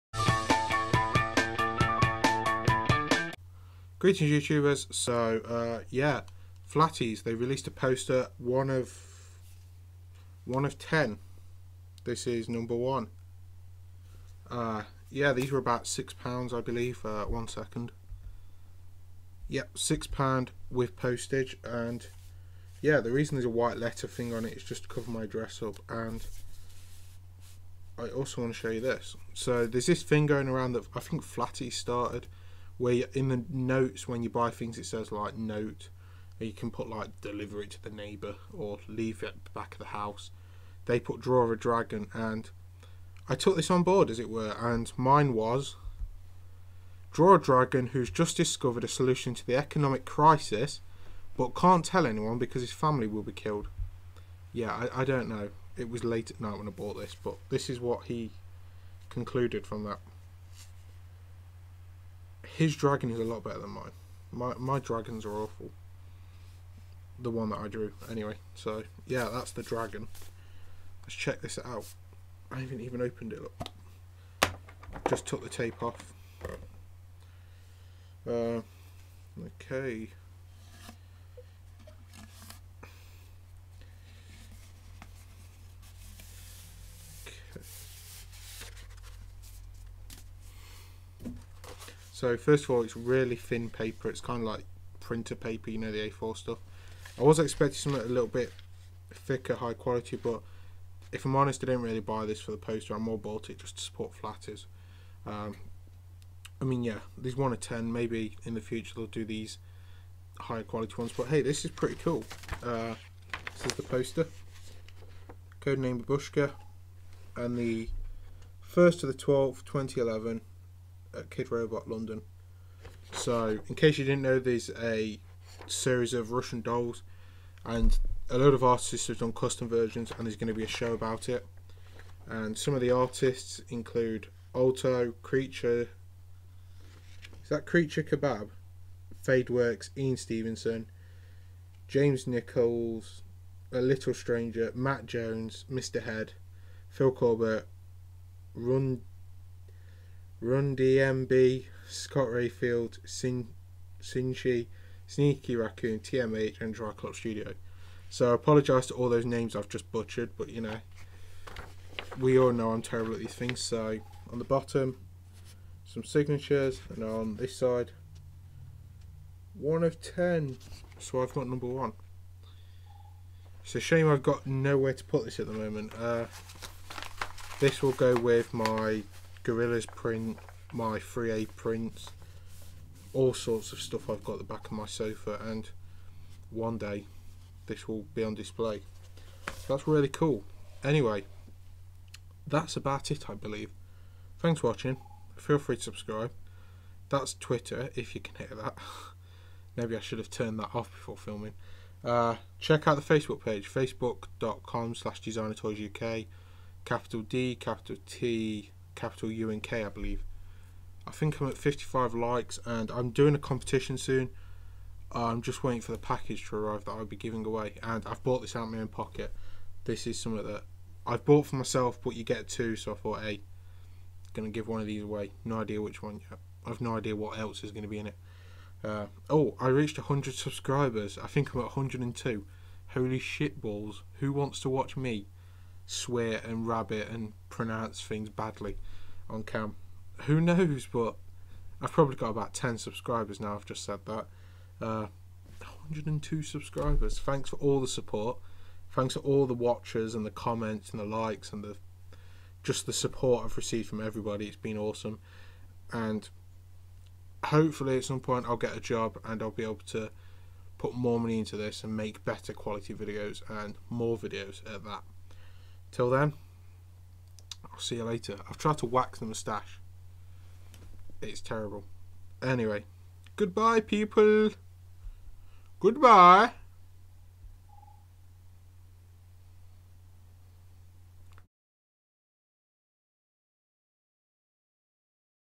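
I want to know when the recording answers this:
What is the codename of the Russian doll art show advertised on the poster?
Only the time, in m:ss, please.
1:55.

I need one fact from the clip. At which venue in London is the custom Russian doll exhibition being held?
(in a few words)
Kidrobot London.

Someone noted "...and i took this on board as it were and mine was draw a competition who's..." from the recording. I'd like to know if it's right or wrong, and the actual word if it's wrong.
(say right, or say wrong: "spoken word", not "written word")
wrong: "dragon", not "competition".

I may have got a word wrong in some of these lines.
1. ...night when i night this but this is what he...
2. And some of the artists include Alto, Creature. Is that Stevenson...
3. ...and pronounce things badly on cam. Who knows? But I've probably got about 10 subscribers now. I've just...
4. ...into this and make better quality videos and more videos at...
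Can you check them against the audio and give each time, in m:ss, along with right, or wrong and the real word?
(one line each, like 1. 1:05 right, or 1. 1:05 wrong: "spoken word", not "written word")
1. 0:56 wrong: "bought", not "night"
2. 2:12 wrong: "Creature", not "Stevenson"
3. 3:57 right
4. 4:21 right.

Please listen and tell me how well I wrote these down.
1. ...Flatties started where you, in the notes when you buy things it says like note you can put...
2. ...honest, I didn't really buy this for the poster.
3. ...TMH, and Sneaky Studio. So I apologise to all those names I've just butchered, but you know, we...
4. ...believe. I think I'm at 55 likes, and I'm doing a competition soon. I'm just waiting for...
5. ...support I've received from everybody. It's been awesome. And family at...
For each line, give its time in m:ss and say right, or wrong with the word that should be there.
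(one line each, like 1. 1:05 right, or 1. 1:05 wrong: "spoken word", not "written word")
1. 0:31 right
2. 1:41 right
3. 2:35 wrong: "Triclops", not "Sneaky"
4. 3:29 right
5. 4:12 wrong: "hopefully", not "family".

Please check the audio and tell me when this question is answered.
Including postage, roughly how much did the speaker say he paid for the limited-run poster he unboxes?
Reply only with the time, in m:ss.
0:19.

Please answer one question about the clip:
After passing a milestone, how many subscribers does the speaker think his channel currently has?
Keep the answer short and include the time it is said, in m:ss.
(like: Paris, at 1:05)
102, at 3:51.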